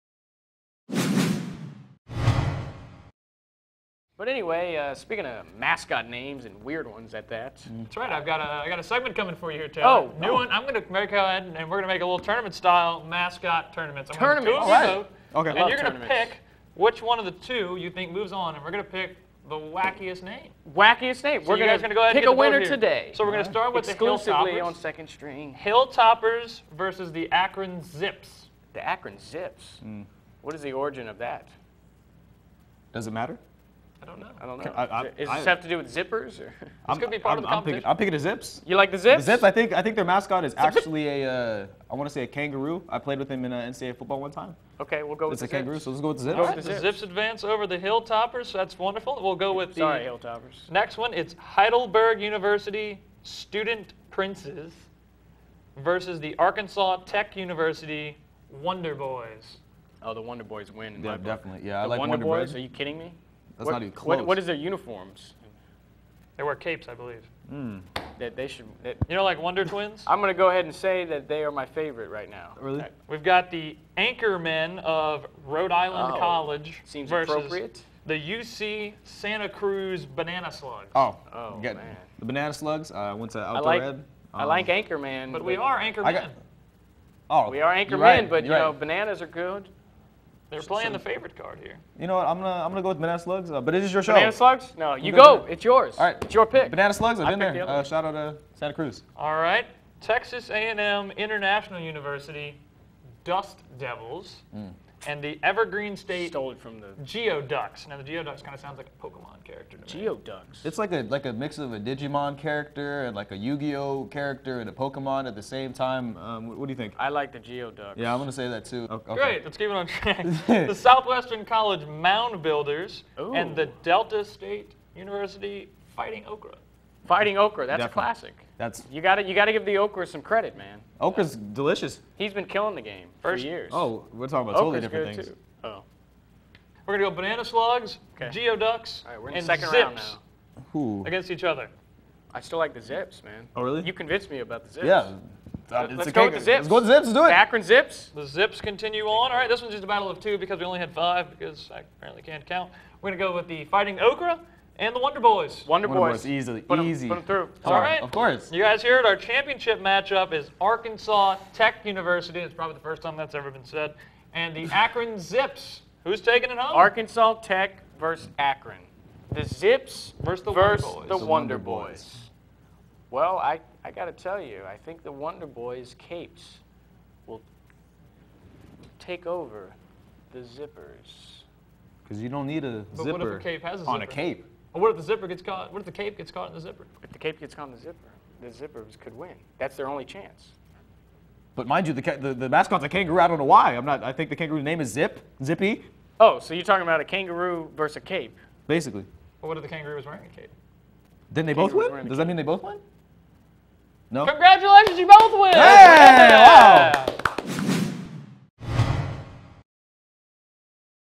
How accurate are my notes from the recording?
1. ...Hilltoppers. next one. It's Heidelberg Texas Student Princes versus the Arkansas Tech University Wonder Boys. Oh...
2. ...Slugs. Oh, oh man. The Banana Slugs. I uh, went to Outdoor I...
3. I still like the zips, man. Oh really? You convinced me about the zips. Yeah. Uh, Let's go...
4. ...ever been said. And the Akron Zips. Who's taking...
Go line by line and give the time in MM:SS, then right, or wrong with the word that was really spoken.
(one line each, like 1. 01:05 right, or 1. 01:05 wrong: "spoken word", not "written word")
1. 00:50 wrong: "University", not "Texas"
2. 01:20 right
3. 02:22 right
4. 02:43 right.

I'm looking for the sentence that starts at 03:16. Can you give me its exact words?
Oh, so you're talking about a kangaroo versus a cape?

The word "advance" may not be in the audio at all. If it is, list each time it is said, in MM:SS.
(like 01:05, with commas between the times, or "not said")
00:47.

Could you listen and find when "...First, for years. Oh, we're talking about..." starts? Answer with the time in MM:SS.
02:13.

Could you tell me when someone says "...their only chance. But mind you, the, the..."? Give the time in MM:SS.
03:09.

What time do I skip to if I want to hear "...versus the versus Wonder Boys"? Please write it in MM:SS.
02:50.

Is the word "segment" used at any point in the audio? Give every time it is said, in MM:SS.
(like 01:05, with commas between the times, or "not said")
00:08.